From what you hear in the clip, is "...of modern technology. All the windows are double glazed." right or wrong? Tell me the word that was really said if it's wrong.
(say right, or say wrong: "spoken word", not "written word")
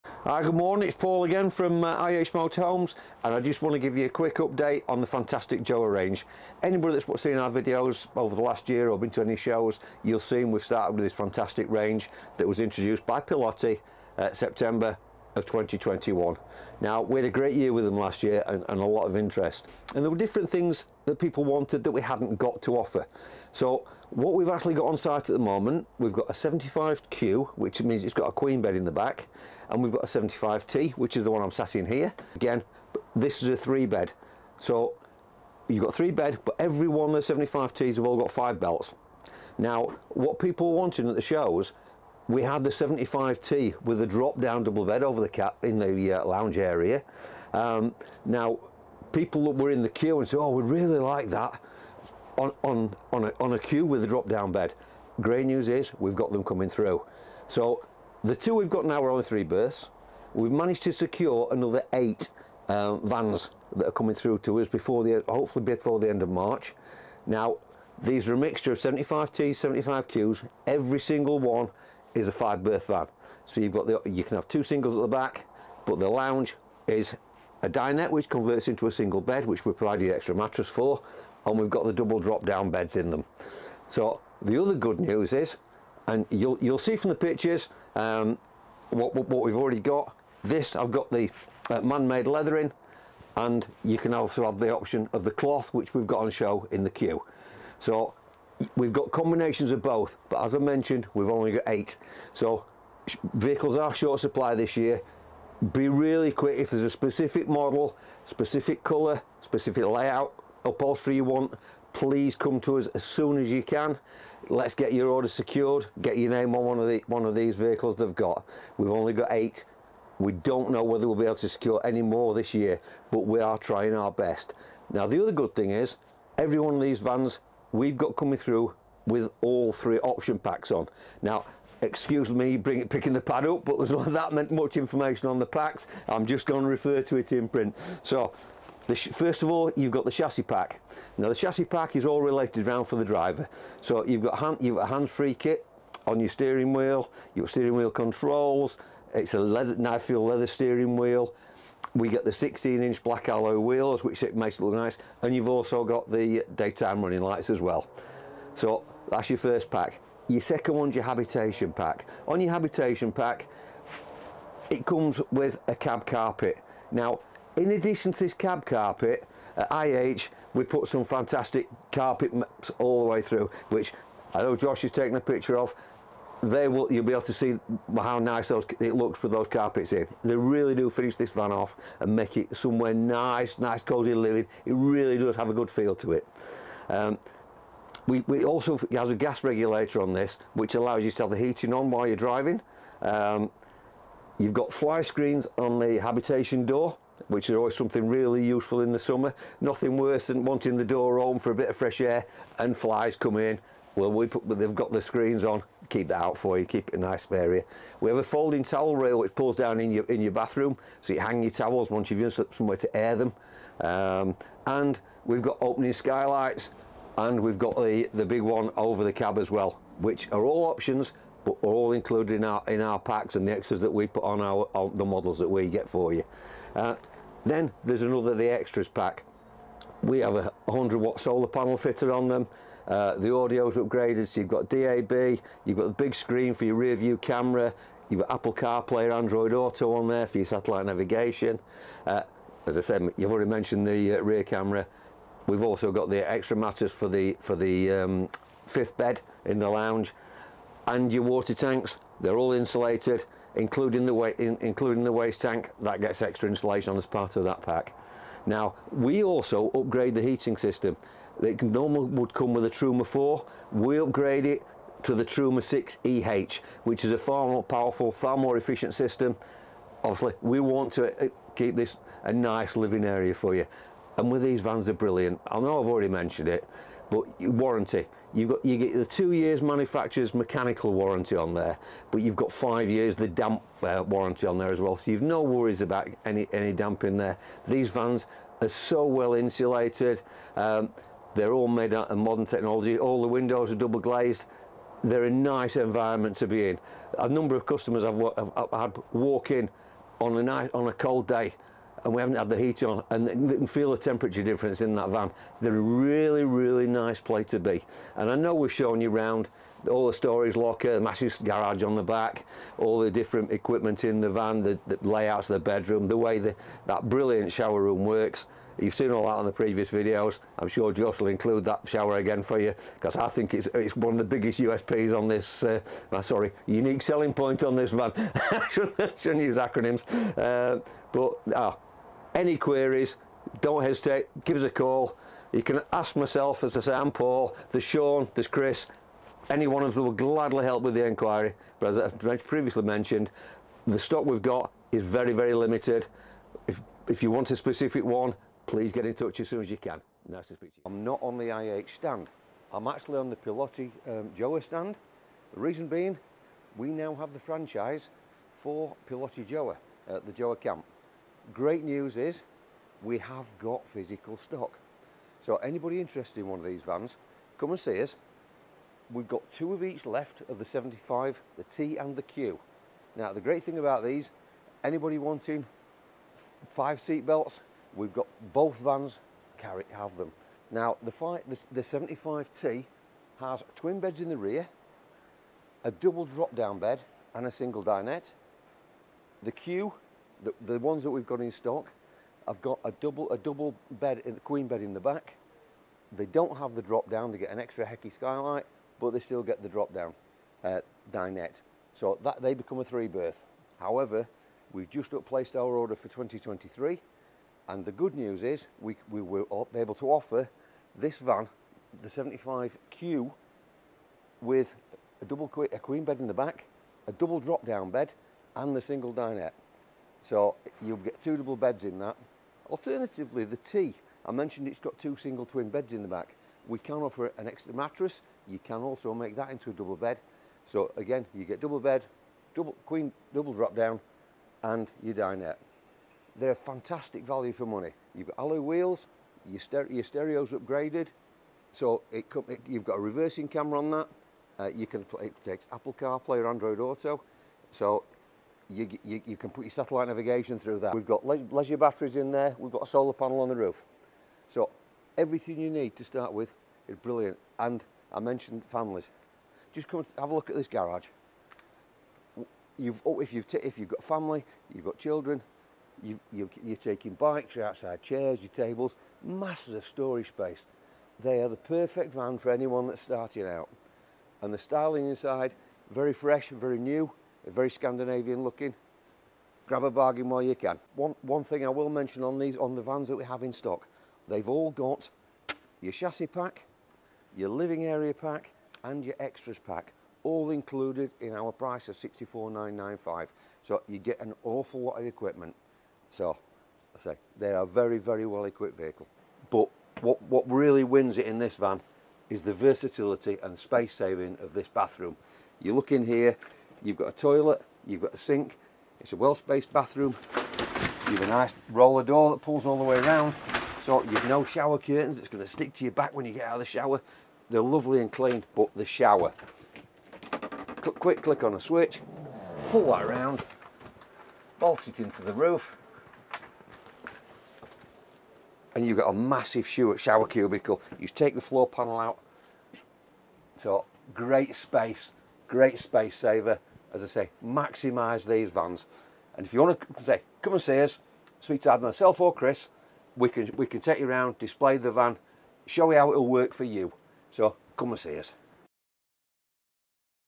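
right.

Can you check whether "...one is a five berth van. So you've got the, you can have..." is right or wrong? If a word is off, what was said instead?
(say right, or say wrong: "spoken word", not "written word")
right.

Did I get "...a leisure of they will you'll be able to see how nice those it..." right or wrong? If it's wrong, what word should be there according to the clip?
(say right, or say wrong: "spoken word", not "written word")
wrong: "picture", not "leisure".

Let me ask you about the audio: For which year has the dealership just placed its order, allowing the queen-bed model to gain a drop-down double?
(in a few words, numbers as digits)
2023.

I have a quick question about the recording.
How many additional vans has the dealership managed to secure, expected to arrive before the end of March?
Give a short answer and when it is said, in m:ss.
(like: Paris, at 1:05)
8, at 1:01.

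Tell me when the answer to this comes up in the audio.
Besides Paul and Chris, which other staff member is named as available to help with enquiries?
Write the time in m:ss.
5:37.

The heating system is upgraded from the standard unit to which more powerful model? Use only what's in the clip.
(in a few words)
Truma 6 EH.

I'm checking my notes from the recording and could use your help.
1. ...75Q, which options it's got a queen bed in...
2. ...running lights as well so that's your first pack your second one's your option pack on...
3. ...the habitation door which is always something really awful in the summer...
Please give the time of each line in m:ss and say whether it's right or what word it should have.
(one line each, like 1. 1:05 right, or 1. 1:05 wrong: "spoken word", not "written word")
1. 0:26 wrong: "means", not "options"
2. 2:37 wrong: "habitation", not "option"
3. 3:15 wrong: "useful", not "awful".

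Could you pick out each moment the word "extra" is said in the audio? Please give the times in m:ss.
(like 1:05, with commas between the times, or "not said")
1:20, 3:43, 3:48, 4:06, 4:16, 6:37, 7:07, 8:09.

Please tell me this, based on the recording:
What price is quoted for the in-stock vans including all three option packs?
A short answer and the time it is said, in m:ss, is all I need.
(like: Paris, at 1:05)
£64,995, at 8:11.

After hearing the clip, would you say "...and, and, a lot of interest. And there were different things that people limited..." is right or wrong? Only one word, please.
wrong.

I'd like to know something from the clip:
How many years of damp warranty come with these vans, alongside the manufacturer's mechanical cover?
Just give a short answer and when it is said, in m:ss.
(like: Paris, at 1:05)
5 years, at 4:42.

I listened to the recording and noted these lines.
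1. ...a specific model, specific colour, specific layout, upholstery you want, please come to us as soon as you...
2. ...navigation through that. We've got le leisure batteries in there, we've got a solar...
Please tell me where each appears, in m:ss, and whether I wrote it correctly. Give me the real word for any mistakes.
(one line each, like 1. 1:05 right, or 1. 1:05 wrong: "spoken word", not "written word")
1. 1:46 right
2. 7:30 right.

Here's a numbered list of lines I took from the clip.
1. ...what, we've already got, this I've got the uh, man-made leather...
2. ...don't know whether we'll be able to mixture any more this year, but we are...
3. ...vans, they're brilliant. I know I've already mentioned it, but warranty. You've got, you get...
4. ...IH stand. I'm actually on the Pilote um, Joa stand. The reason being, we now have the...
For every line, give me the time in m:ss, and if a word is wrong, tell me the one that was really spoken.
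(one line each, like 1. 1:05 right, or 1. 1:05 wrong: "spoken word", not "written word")
1. 1:29 right
2. 2:00 wrong: "secure", not "mixture"
3. 4:34 right
4. 5:51 right.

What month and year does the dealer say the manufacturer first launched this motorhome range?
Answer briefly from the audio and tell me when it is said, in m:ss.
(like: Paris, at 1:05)
September 2021, at 0:14.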